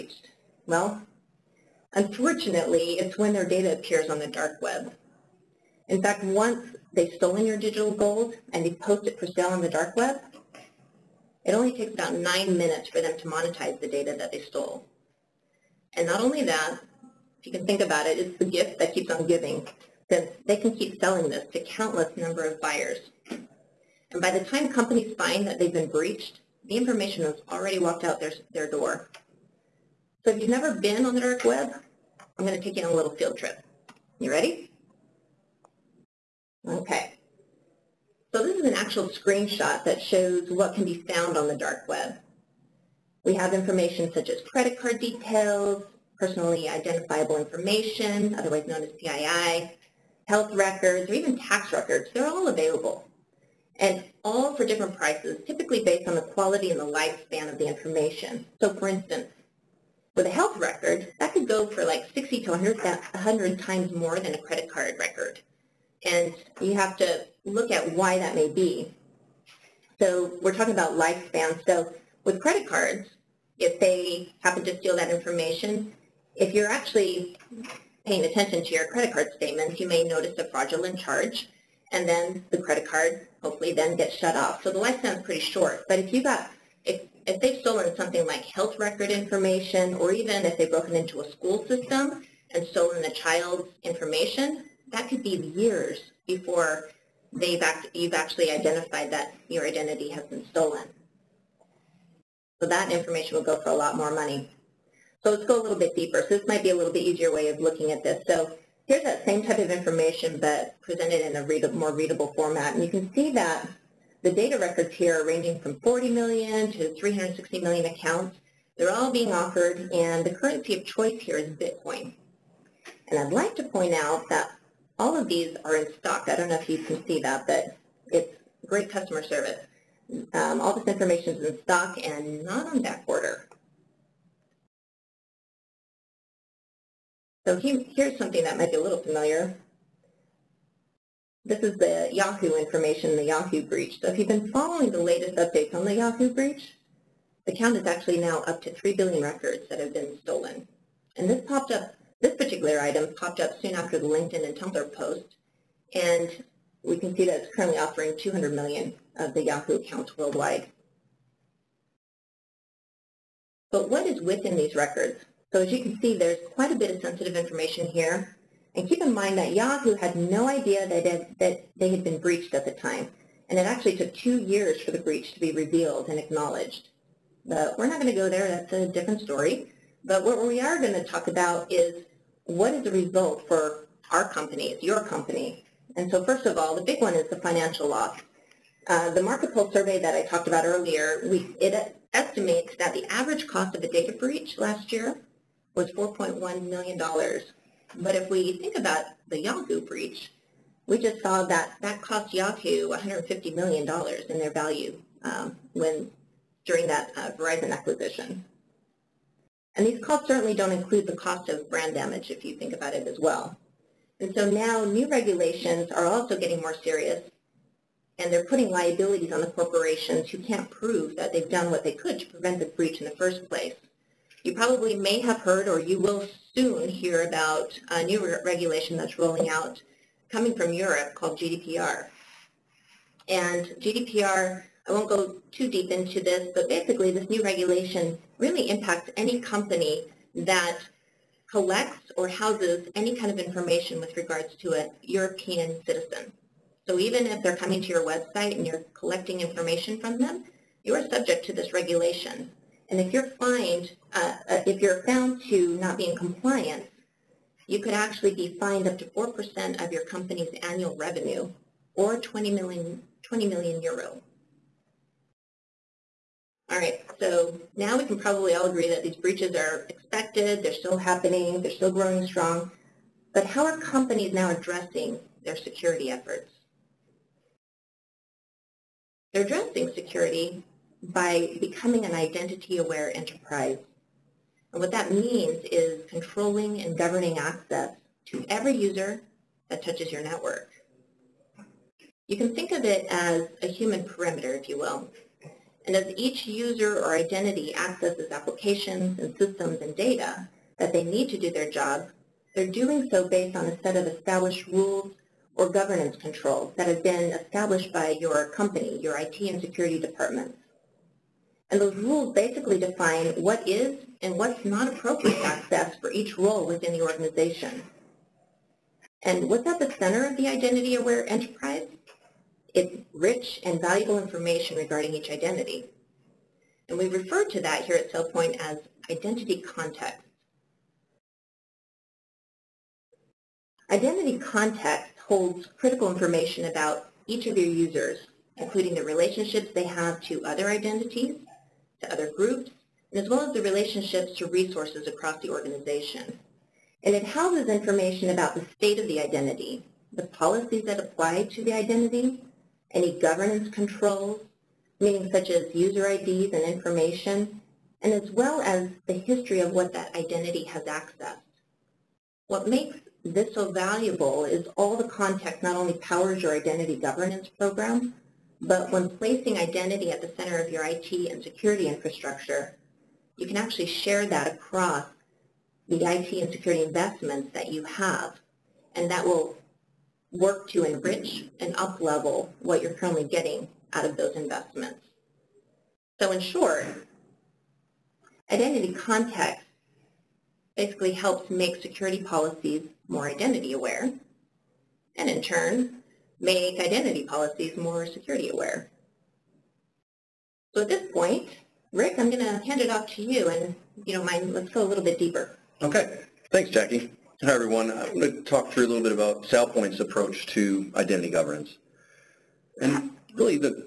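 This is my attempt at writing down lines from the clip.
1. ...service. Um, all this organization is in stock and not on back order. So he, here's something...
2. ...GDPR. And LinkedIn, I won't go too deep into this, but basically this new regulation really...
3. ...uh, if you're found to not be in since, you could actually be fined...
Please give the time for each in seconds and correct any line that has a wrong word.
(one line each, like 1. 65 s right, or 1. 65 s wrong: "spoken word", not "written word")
1. 129 s wrong: "information", not "organization"
2. 231 s wrong: "GDPR", not "LinkedIn"
3. 254 s wrong: "compliance", not "since".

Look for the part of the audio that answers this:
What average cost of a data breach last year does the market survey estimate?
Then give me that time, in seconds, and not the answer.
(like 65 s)
195 s.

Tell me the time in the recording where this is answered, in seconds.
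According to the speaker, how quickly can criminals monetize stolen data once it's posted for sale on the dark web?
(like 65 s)
12 s.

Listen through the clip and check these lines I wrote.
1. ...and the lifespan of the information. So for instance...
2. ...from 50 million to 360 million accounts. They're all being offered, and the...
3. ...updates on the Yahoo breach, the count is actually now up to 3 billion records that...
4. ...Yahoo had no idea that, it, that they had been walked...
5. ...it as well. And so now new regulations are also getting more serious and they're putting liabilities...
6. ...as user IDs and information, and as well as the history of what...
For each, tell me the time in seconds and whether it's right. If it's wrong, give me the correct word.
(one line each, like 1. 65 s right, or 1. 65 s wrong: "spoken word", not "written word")
1. 56 s right
2. 115 s wrong: "40", not "50"
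3. 145 s right
4. 169 s wrong: "breached", not "walked"
5. 212 s right
6. 355 s right.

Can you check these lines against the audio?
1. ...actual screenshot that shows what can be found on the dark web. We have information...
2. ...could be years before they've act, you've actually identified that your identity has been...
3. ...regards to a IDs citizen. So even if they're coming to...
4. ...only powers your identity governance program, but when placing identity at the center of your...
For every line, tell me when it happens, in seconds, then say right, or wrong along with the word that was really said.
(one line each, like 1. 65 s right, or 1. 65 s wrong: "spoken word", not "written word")
1. 38 s right
2. 95 s right
3. 244 s wrong: "European", not "IDs"
4. 365 s right.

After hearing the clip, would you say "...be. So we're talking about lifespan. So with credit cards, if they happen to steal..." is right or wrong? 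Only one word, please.
right.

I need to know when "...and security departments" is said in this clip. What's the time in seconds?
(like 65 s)
309 s.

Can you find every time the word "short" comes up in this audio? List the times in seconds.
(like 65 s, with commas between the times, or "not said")
85 s, 386 s.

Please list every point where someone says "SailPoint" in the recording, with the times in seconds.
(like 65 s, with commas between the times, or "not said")
328 s, 409 s.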